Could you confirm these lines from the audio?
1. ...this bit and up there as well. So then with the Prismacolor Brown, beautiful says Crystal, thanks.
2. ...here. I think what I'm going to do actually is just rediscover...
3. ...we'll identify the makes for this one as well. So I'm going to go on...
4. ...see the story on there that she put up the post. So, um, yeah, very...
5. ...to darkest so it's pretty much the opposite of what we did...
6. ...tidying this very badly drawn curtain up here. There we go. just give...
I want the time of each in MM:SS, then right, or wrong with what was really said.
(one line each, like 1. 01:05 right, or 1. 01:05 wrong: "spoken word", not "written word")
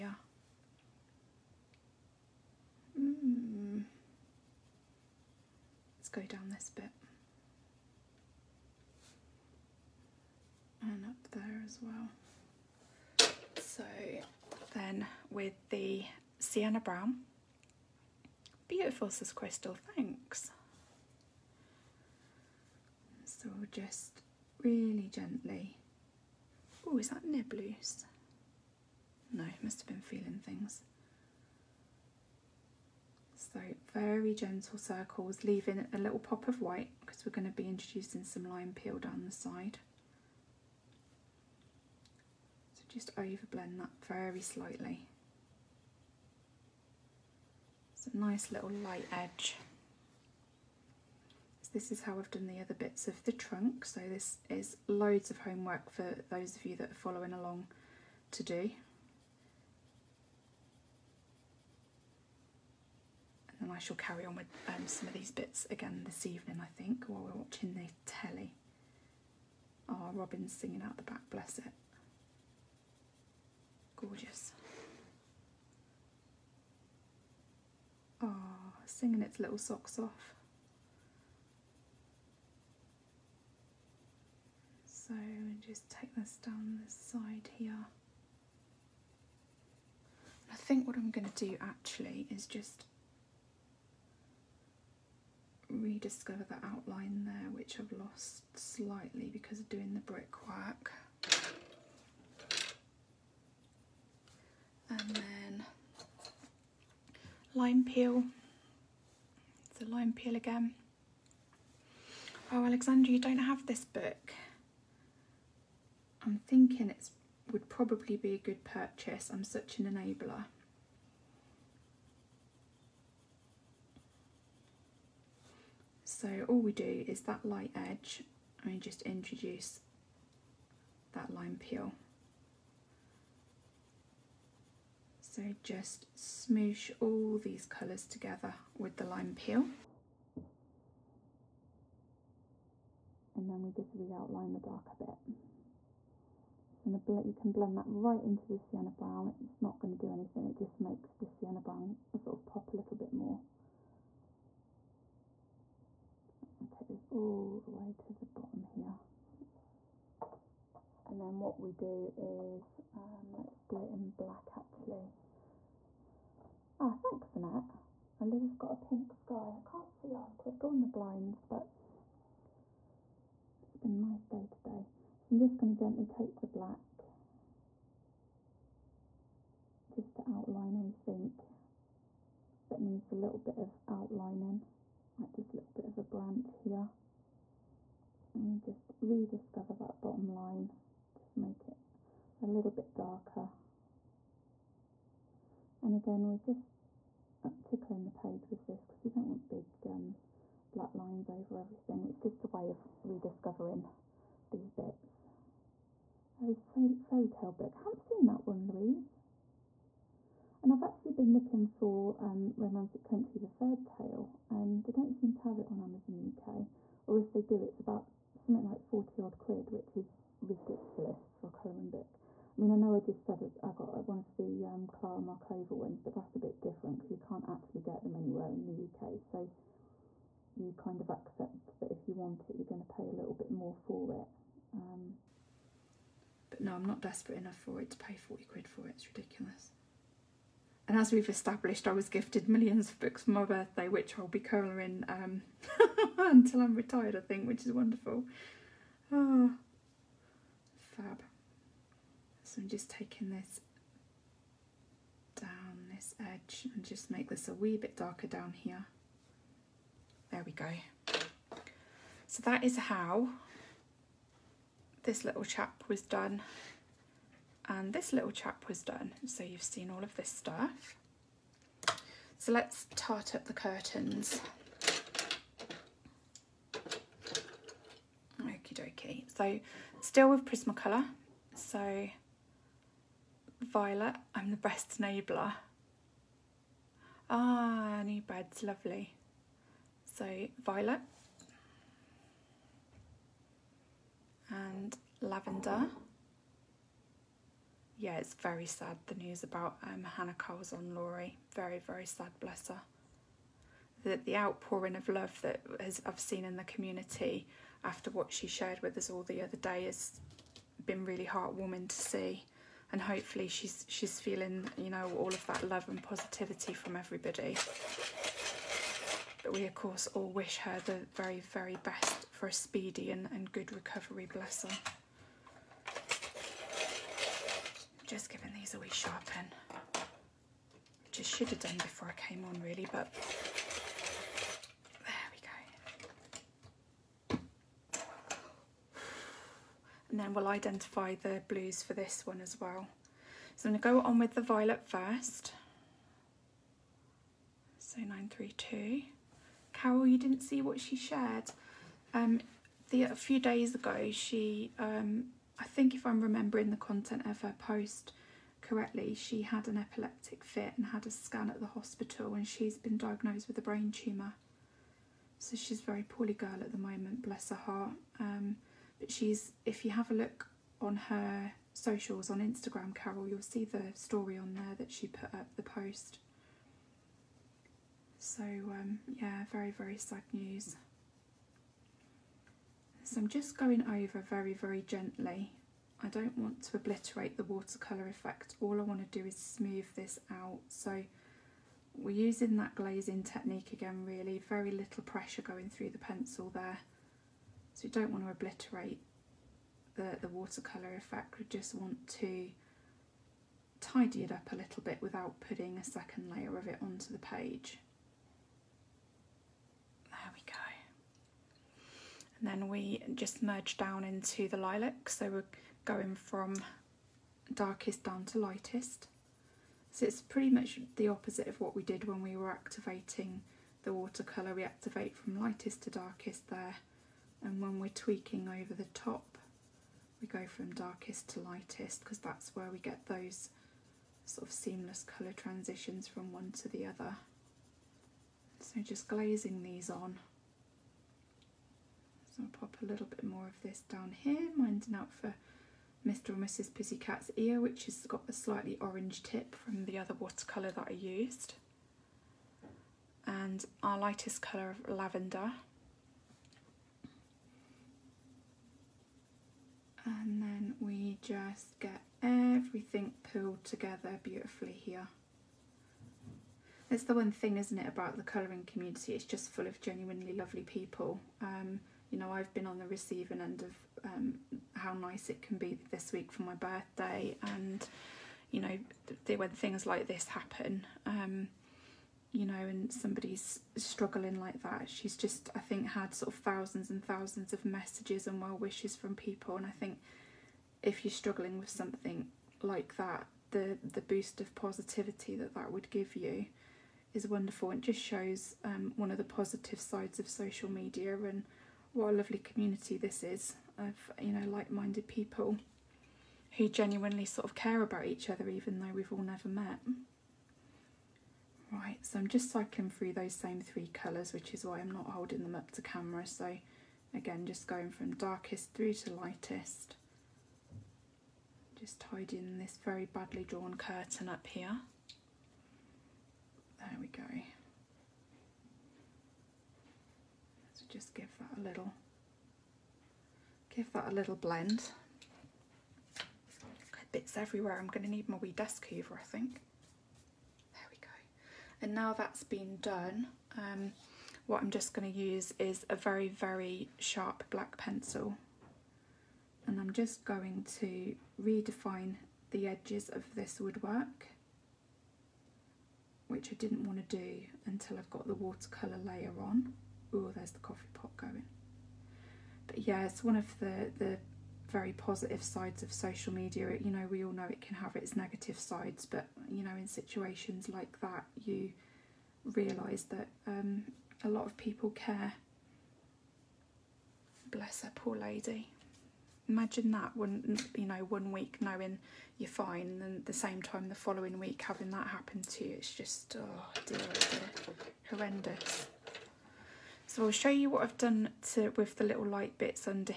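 1. 00:06 wrong: "Sienna", not "Prismacolor"
2. 01:27 right
3. 05:40 wrong: "blues", not "makes"
4. 06:13 right
5. 06:58 wrong: "lightest", not "darkest"
6. 08:41 right.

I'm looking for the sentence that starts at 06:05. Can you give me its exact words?
So she's a very poorly girl at the moment, bless her heart.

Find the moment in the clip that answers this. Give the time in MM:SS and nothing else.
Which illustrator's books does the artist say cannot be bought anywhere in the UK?
03:44.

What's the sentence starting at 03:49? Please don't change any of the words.
So you kind of accept that if you want it, you're going to pay a little bit more for it.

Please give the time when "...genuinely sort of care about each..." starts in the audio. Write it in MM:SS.
08:26.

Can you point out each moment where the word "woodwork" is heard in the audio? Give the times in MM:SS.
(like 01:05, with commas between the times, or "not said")
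09:13.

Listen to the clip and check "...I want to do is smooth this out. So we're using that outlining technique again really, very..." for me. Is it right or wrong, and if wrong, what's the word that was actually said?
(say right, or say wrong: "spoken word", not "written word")
wrong: "glazing", not "outlining".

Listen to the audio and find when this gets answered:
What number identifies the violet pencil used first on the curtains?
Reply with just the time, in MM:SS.
05:47.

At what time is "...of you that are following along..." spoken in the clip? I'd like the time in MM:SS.
00:56.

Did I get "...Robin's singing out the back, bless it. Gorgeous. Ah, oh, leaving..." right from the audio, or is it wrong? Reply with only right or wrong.
wrong.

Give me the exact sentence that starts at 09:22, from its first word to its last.
But yeah, it's one of the the very positive sides of social media.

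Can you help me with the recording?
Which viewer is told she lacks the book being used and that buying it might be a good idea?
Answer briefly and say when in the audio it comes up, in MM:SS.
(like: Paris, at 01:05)
Alexandra, at 01:52.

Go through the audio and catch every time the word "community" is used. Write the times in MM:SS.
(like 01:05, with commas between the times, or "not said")
05:06, 07:48, 08:22.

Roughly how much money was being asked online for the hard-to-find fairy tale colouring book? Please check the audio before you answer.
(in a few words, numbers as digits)
£40.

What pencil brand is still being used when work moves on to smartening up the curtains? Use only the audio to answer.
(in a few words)
Prismacolor.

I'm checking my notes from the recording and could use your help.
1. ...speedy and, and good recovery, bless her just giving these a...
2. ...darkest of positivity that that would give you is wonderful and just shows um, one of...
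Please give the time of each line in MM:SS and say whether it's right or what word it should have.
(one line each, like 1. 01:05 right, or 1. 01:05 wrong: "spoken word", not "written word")
1. 05:22 right
2. 08:14 wrong: "boost", not "darkest".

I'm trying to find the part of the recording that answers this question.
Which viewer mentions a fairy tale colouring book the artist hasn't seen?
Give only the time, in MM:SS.
03:28.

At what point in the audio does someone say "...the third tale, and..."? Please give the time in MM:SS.
03:33.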